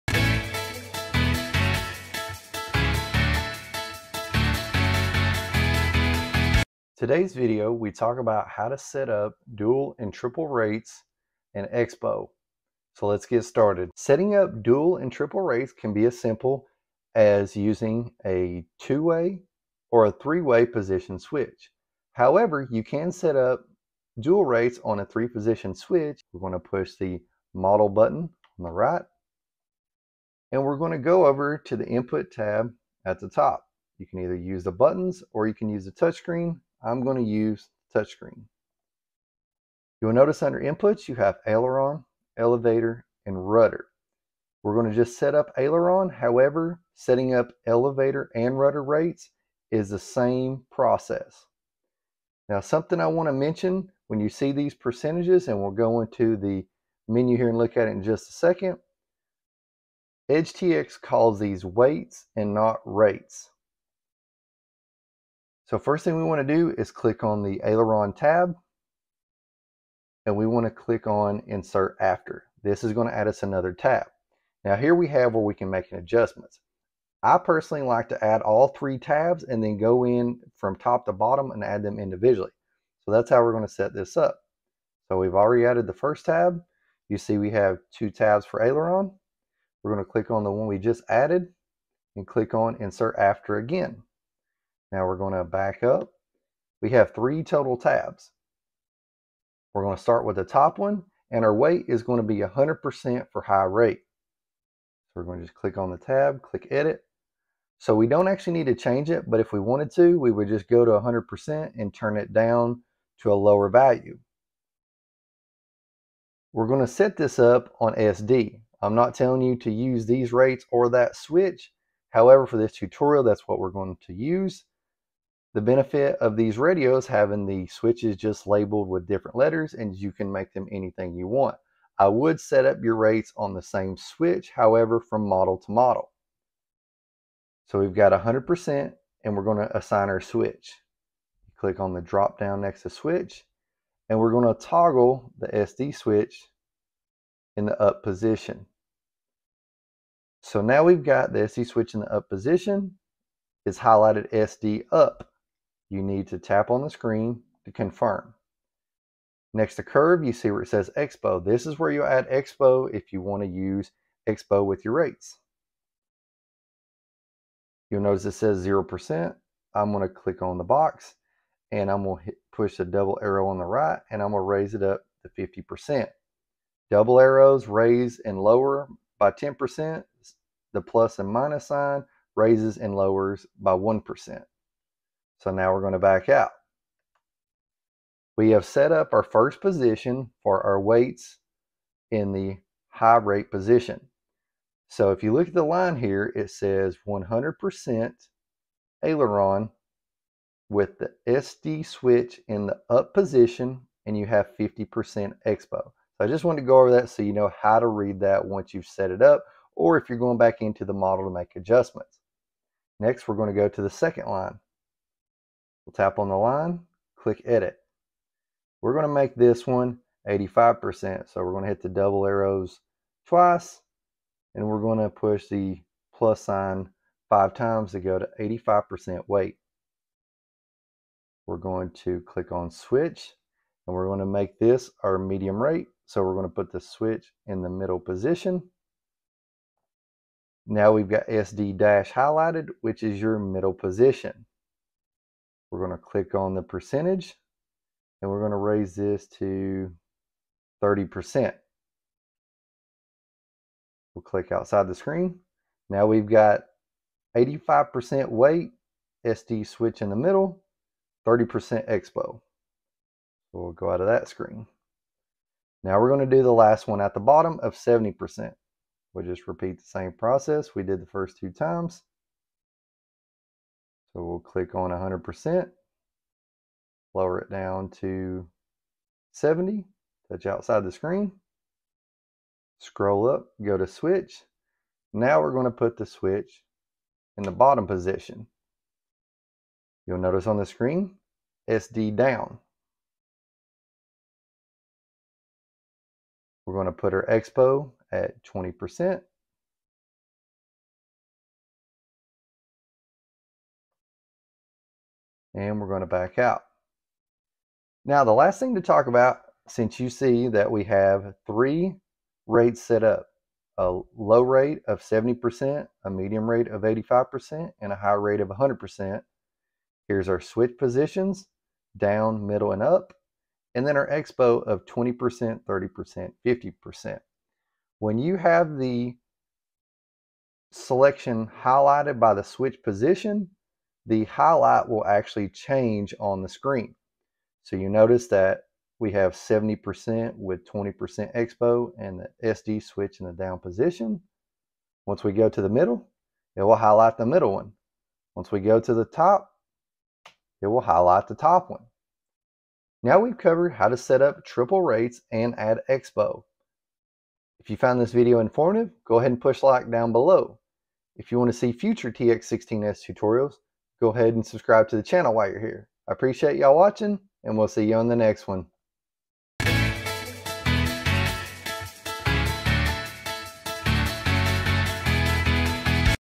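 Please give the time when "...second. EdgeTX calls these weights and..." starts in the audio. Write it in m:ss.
0:58.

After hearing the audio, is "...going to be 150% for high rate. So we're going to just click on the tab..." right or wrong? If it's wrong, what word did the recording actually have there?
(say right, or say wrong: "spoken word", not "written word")
wrong: "100", not "150".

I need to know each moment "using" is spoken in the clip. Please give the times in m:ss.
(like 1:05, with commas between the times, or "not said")
0:17.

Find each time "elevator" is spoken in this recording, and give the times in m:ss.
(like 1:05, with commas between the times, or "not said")
0:42, 0:47.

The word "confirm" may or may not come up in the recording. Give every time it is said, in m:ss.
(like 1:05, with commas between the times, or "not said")
2:37.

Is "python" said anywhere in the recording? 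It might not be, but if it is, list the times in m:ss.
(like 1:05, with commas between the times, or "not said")
not said.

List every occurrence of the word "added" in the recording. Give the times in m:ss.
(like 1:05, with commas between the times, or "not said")
1:25, 1:31.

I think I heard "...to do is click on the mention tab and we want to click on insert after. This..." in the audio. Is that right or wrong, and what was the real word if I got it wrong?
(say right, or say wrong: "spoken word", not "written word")
wrong: "aileron", not "mention".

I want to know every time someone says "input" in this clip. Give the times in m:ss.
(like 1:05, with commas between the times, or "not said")
0:31, 0:40.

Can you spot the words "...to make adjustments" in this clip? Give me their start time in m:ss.
3:31.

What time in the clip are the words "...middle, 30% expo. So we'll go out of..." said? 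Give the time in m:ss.
4:20.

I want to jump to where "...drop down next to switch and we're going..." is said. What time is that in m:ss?
2:22.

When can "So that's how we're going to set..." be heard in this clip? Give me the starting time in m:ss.
1:22.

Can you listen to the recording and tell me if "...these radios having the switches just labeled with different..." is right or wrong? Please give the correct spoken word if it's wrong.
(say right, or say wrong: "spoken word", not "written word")
right.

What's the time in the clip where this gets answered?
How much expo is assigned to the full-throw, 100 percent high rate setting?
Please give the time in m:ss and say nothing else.
2:54.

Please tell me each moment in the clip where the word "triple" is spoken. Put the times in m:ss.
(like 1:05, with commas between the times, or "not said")
0:10, 0:15, 5:54.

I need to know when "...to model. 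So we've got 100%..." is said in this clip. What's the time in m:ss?
2:15.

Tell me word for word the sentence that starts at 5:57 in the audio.
If you found this video informative, go ahead and push like down below.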